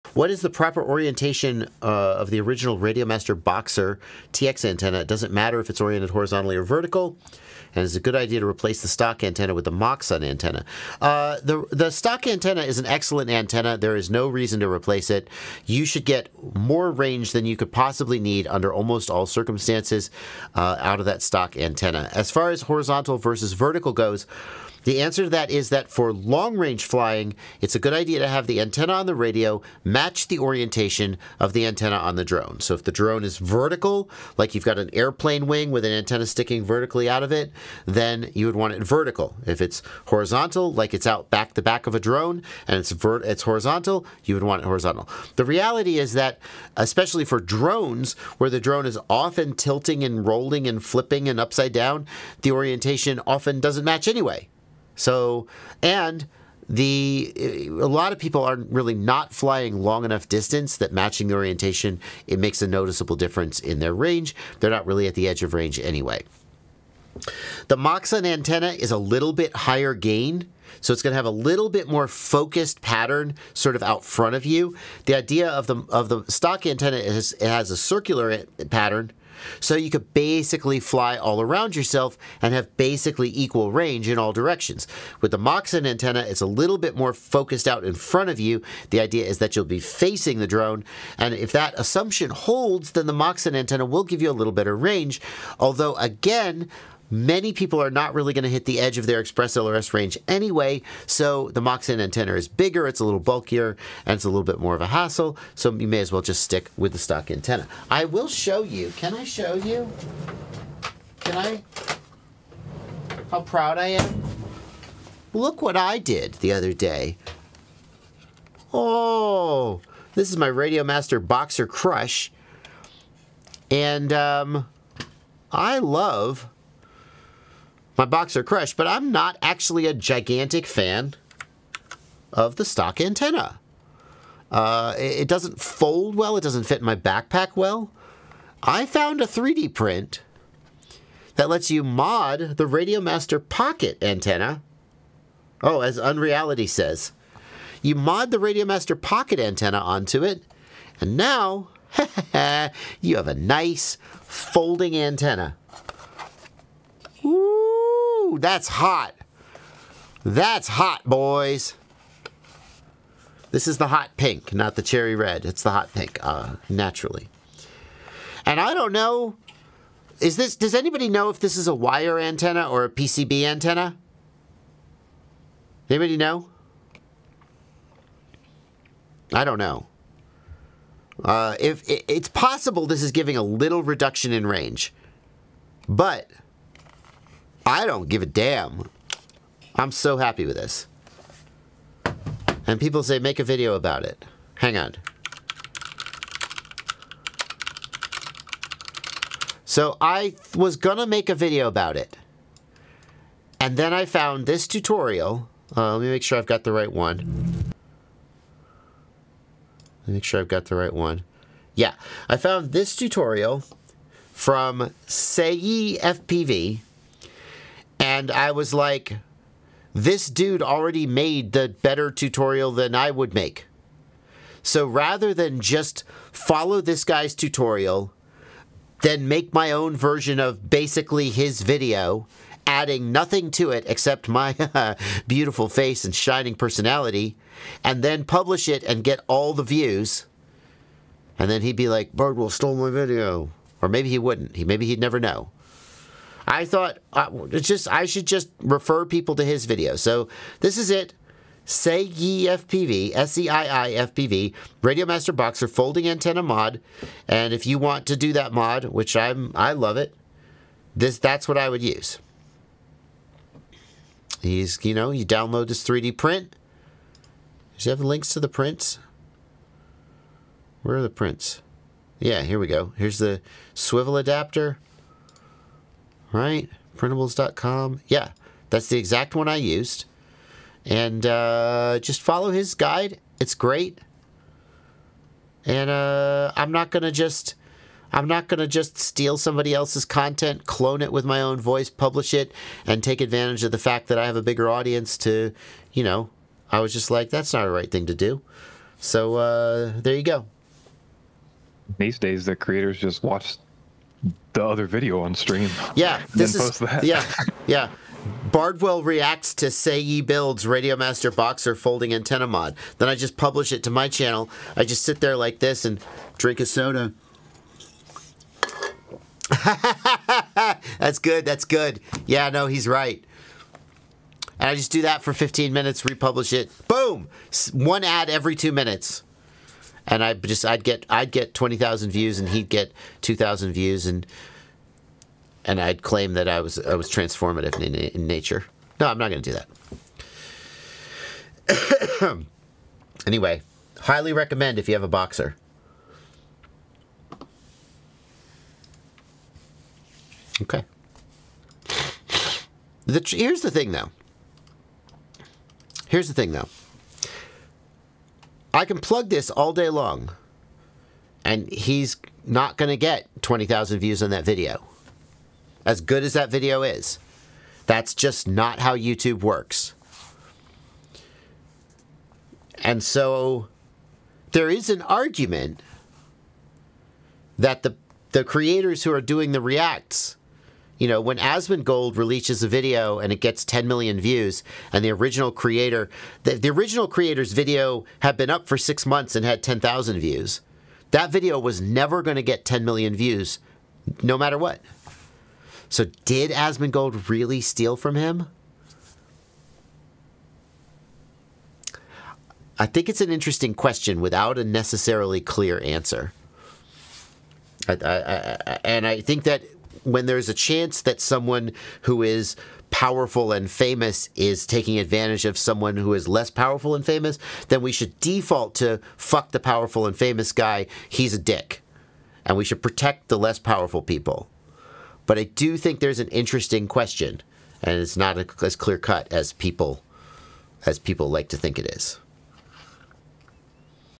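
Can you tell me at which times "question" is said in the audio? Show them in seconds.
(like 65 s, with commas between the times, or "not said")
403 s, 426 s.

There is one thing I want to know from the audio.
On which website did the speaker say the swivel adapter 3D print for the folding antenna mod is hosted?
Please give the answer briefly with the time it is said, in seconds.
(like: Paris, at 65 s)
Printables.com, at 276 s.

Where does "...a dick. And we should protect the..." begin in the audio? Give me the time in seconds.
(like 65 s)
421 s.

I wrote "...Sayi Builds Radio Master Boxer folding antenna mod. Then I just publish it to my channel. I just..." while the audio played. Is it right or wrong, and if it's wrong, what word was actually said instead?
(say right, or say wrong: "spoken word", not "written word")
right.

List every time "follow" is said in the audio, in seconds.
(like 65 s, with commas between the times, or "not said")
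226 s, 282 s.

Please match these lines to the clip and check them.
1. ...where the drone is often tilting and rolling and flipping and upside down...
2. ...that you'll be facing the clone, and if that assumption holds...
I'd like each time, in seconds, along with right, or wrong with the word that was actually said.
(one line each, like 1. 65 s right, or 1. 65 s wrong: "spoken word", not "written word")
1. 48 s right
2. 89 s wrong: "drone", not "clone".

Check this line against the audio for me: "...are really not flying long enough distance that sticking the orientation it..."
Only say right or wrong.
wrong.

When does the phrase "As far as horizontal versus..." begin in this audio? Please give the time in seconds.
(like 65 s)
22 s.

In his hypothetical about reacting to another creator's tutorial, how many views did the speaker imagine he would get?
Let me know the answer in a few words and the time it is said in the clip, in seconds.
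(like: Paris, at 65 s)
20,000, at 331 s.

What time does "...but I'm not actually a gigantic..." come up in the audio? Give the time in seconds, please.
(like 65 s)
128 s.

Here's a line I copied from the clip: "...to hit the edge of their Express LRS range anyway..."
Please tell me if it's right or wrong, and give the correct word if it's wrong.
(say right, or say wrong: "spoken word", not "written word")
right.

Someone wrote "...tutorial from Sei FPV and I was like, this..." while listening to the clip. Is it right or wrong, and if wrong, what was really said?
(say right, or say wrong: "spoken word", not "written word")
right.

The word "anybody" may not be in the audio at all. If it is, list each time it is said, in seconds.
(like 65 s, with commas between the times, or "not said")
170 s, 175 s.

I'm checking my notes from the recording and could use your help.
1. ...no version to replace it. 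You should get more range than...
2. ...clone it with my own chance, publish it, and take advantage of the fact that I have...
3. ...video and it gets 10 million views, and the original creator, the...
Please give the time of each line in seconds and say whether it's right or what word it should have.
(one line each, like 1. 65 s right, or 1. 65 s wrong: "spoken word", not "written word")
1. 14 s wrong: "reason", not "version"
2. 290 s wrong: "voice", not "chance"
3. 382 s right.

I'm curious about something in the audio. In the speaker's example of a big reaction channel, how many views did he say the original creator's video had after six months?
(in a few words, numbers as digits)
10,000.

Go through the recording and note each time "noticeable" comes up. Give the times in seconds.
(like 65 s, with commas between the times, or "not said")
62 s.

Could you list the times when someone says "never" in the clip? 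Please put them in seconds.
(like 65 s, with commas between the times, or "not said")
244 s, 391 s.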